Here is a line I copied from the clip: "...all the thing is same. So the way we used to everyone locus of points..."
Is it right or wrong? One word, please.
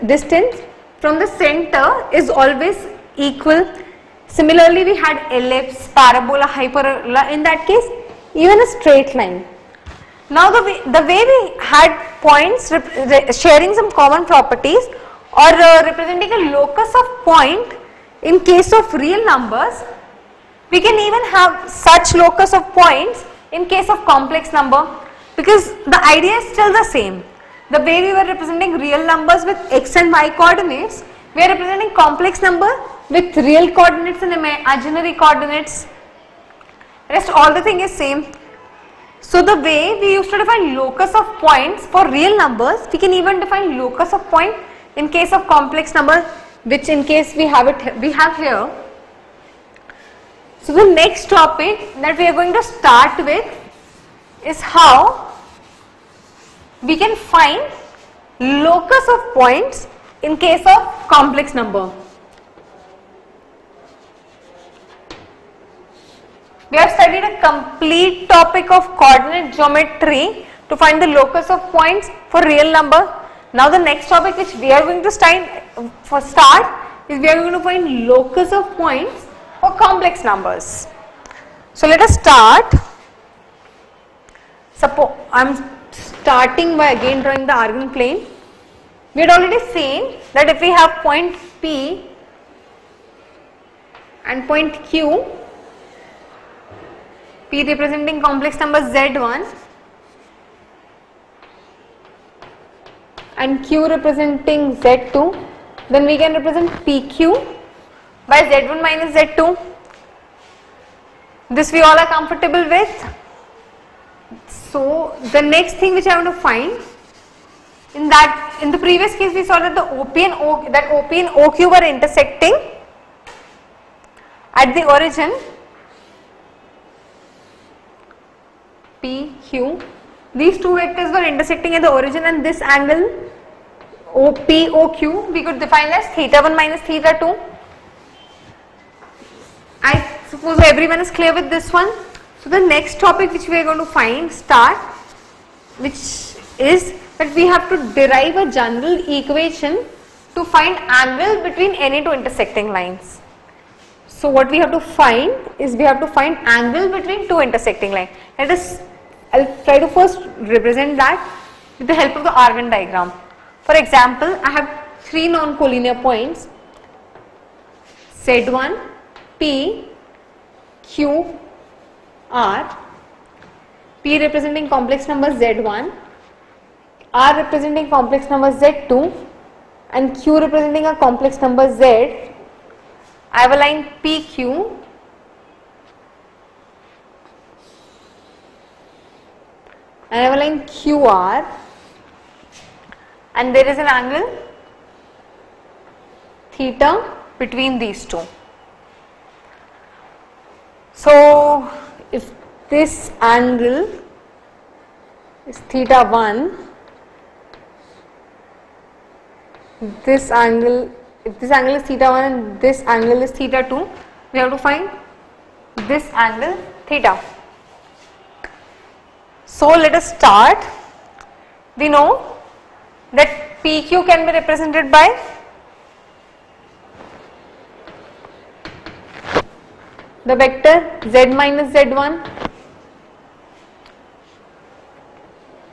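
wrong.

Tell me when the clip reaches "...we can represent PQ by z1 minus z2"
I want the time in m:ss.
1:46.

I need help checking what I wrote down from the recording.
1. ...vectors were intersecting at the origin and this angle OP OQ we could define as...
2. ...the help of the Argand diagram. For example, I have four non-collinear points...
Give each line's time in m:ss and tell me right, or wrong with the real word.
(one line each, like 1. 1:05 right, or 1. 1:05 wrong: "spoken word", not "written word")
1. 2:10 right
2. 2:41 wrong: "three", not "four".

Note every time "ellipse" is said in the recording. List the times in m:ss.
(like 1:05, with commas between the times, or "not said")
0:05.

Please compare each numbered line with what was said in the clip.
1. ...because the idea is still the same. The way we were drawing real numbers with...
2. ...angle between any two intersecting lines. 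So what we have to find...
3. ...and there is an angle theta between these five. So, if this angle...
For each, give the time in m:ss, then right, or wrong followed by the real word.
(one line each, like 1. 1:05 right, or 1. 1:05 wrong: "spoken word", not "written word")
1. 0:25 wrong: "representing", not "drawing"
2. 2:30 right
3. 3:13 wrong: "two", not "five".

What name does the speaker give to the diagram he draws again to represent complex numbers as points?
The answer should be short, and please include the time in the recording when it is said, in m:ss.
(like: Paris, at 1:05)
Argand plane, at 1:27.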